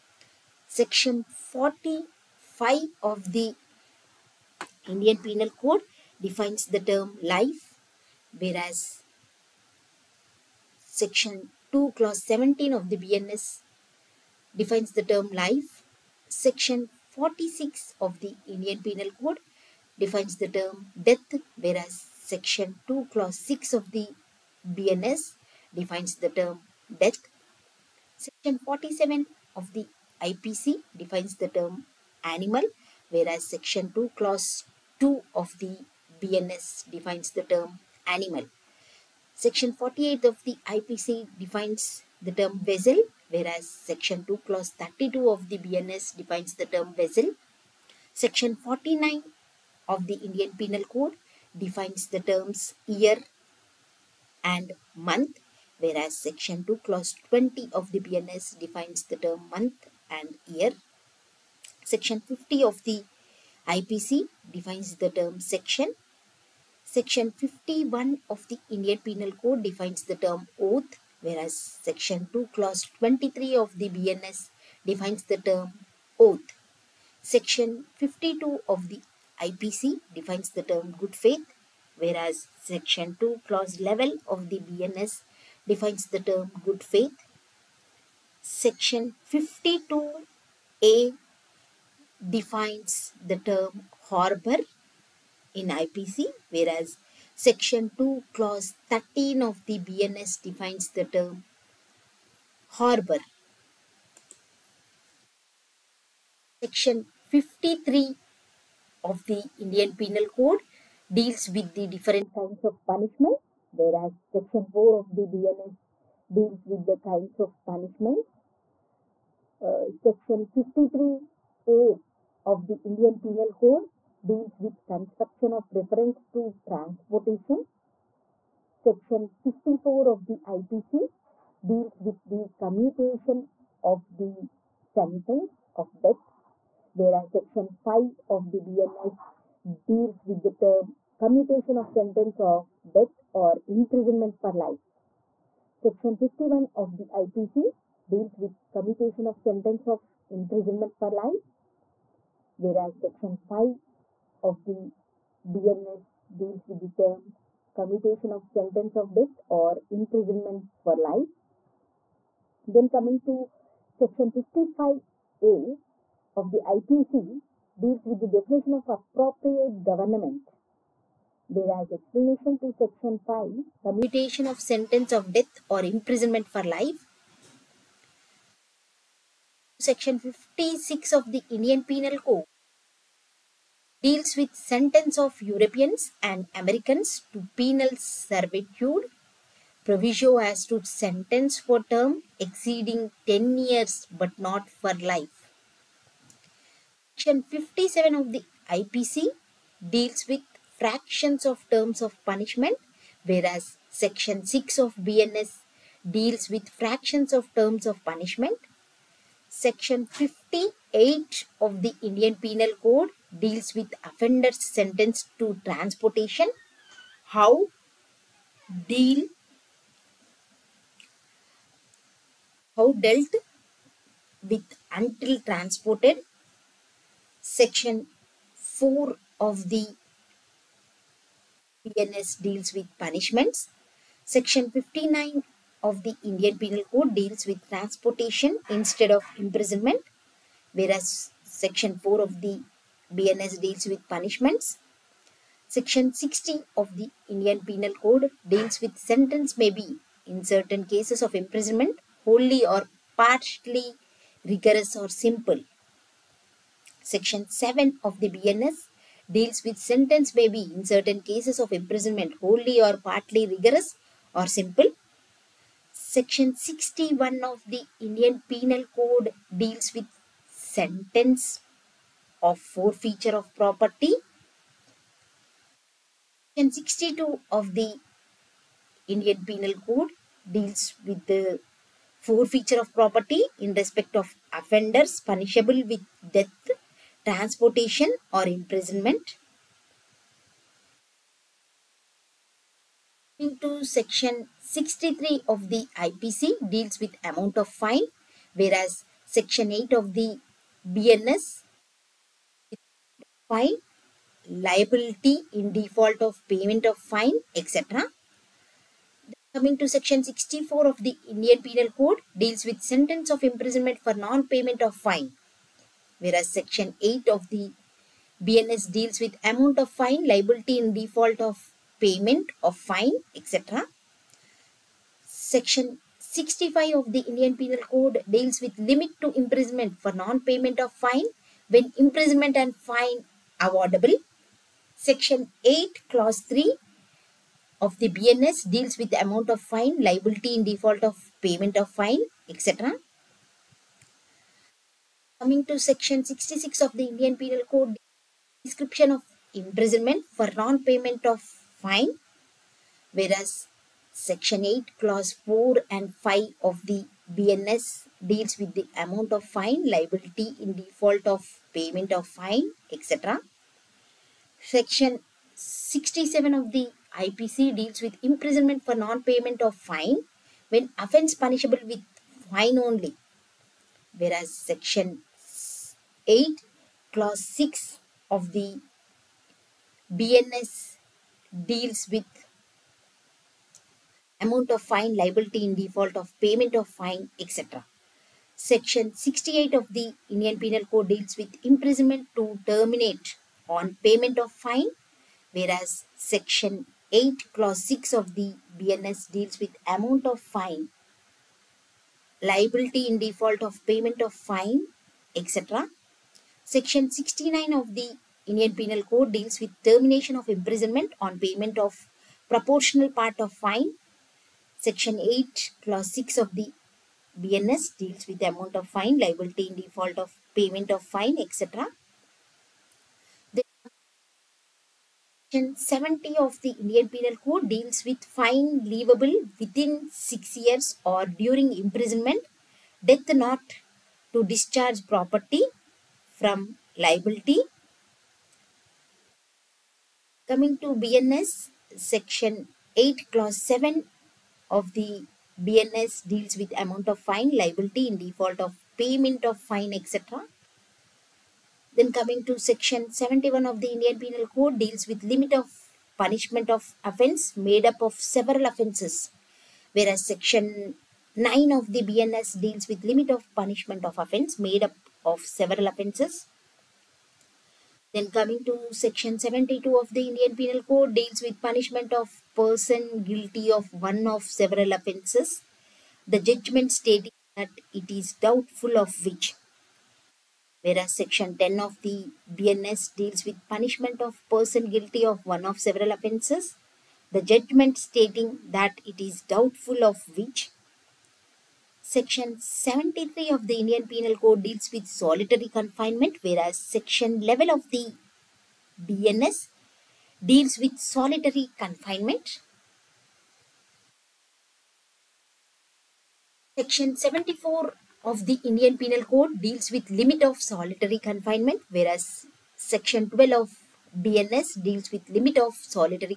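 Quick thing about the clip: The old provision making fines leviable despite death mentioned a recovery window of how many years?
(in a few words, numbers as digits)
6 years.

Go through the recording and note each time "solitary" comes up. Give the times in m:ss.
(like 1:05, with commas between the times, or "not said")
8:15, 8:20, 8:30, 8:35.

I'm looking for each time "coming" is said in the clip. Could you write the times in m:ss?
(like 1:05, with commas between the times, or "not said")
2:42, 5:09, 5:45, 7:20, 7:32, 7:48.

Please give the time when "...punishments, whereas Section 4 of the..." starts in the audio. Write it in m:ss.
1:52.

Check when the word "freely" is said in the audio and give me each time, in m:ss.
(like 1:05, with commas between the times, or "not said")
not said.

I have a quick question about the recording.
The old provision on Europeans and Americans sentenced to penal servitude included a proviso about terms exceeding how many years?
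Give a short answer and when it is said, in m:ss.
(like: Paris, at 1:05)
10 years, at 3:13.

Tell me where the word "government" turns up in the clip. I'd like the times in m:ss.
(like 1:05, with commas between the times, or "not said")
2:49.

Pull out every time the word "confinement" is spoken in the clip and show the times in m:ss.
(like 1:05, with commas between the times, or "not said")
8:15, 8:21, 8:31.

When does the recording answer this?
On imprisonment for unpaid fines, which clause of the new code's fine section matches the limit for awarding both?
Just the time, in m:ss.
5:34.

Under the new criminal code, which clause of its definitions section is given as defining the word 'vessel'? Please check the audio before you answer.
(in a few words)
Clause 32.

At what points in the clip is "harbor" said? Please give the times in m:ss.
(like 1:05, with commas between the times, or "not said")
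1:34, 1:42.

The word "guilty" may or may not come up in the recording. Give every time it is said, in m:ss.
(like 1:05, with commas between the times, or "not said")
7:53, 8:04.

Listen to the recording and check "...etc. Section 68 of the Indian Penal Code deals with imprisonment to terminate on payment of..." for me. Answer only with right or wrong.
right.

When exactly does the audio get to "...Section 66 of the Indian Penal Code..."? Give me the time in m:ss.
5:45.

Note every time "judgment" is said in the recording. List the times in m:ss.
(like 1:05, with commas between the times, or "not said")
7:56, 8:07.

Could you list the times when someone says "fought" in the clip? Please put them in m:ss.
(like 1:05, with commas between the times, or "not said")
not said.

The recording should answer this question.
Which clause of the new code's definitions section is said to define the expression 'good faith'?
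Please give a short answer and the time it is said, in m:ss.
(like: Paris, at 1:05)
Clause 11, at 1:22.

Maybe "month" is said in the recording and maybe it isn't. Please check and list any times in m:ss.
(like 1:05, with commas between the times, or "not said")
0:54, 0:59.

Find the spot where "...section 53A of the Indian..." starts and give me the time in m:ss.
1:59.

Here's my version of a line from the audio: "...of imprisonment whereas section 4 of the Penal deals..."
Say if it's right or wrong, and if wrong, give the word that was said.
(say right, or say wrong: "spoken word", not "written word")
wrong: "BNS", not "Penal".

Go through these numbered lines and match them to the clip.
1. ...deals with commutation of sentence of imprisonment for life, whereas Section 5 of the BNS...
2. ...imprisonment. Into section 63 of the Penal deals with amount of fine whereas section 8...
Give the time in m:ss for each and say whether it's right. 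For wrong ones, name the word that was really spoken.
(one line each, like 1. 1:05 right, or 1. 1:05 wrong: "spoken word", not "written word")
1. 2:28 right
2. 4:48 wrong: "IPC", not "Penal".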